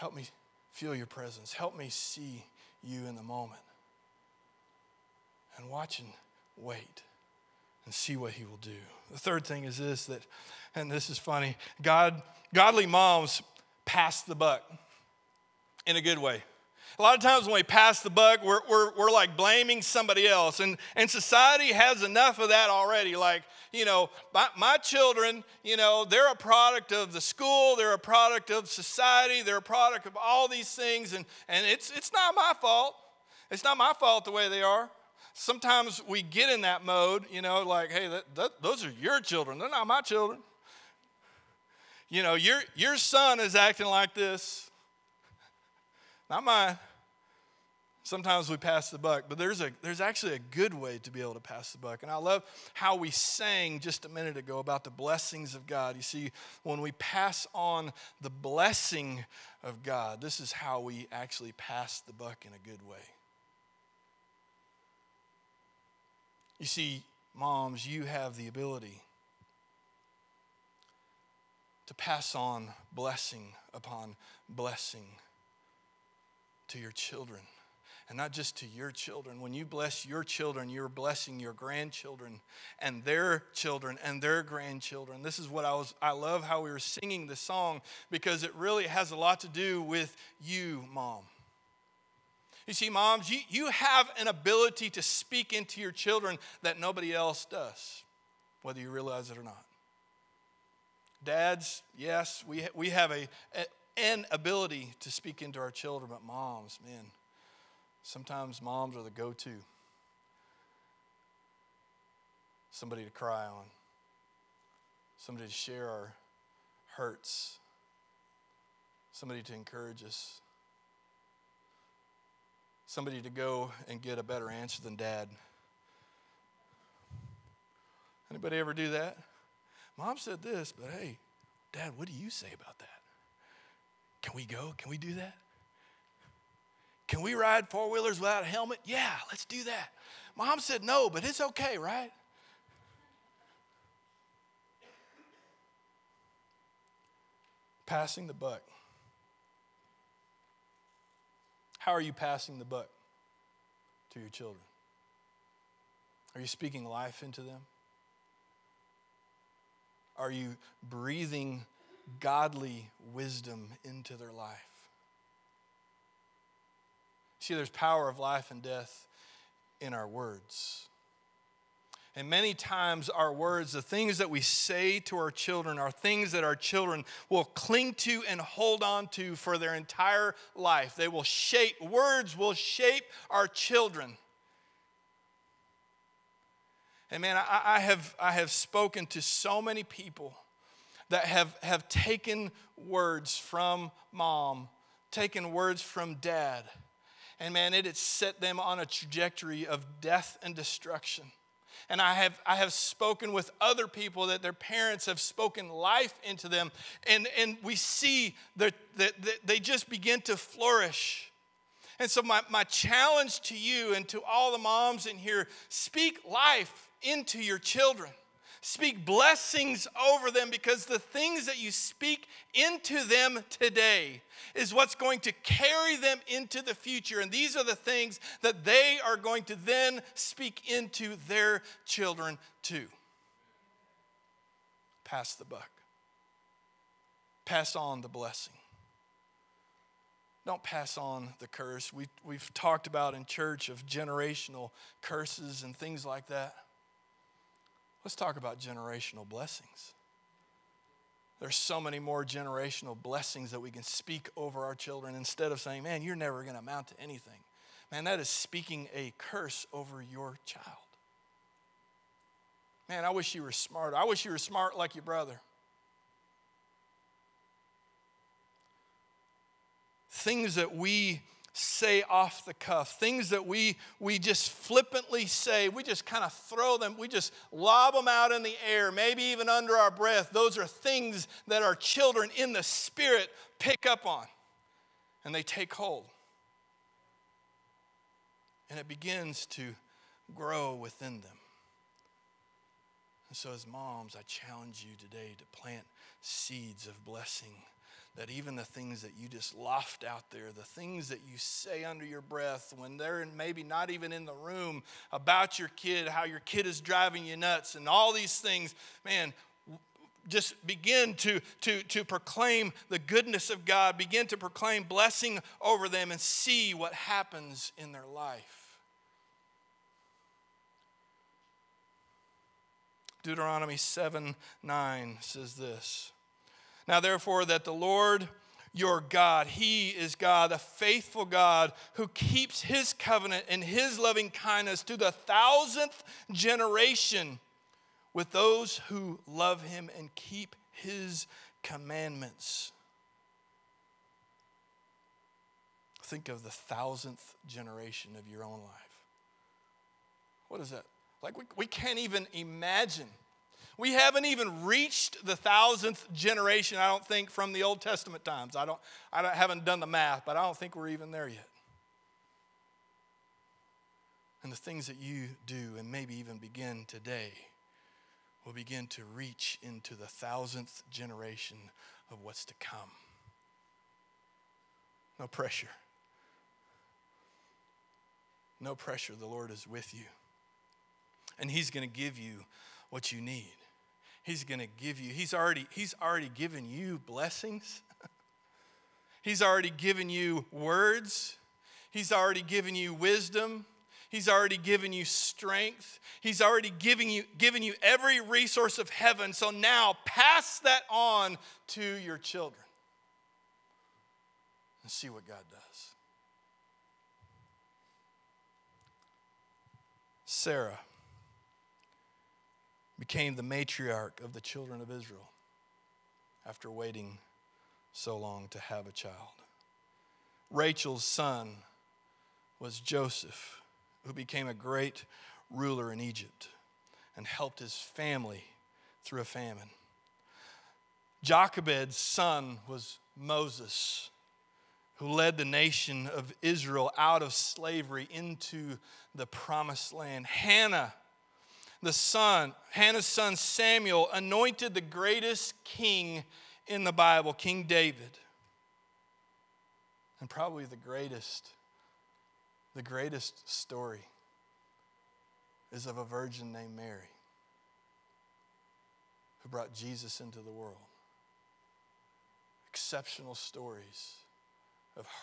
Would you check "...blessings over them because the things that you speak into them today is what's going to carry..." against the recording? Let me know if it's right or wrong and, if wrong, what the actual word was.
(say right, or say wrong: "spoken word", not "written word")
right.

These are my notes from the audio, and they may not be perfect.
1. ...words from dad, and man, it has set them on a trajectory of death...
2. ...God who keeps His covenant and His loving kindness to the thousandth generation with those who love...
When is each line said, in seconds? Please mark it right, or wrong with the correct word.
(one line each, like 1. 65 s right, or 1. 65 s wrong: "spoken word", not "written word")
1. 195 s right
2. 331 s right.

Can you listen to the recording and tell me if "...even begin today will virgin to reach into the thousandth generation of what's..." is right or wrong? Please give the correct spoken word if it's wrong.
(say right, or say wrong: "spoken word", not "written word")
wrong: "begin", not "virgin".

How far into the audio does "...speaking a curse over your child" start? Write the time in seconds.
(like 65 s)
258 s.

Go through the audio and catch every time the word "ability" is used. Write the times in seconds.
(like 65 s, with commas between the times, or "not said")
68 s, 94 s, 104 s.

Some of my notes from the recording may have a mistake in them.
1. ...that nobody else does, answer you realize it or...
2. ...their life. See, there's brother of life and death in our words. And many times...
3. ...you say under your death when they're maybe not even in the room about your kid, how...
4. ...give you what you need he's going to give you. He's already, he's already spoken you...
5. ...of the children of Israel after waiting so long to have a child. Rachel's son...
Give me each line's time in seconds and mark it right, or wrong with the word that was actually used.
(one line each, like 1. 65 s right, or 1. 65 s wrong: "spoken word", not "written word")
1. 96 s wrong: "whether", not "answer"
2. 164 s wrong: "power", not "brother"
3. 301 s wrong: "breath", not "death"
4. 381 s wrong: "given", not "spoken"
5. 414 s right.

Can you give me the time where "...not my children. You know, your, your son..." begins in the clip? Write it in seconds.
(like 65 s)
39 s.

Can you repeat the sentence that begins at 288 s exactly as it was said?
And it begins to grow within them.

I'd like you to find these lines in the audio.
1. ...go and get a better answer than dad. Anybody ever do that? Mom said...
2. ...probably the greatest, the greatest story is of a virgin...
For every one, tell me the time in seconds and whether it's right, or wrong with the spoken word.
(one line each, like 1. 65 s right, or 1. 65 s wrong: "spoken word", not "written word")
1. 123 s right
2. 450 s right.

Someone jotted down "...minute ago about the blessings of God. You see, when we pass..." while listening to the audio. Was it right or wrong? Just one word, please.
right.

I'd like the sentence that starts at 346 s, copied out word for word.
Think of the thousandth generation of your own life.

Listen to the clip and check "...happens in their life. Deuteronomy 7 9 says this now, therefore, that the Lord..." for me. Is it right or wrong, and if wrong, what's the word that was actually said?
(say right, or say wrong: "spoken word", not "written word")
right.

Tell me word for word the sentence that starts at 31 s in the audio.
And, and it's, it's not my fault.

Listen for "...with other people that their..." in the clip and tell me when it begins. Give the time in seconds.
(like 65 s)
203 s.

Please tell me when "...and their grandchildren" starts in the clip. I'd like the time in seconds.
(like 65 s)
84 s.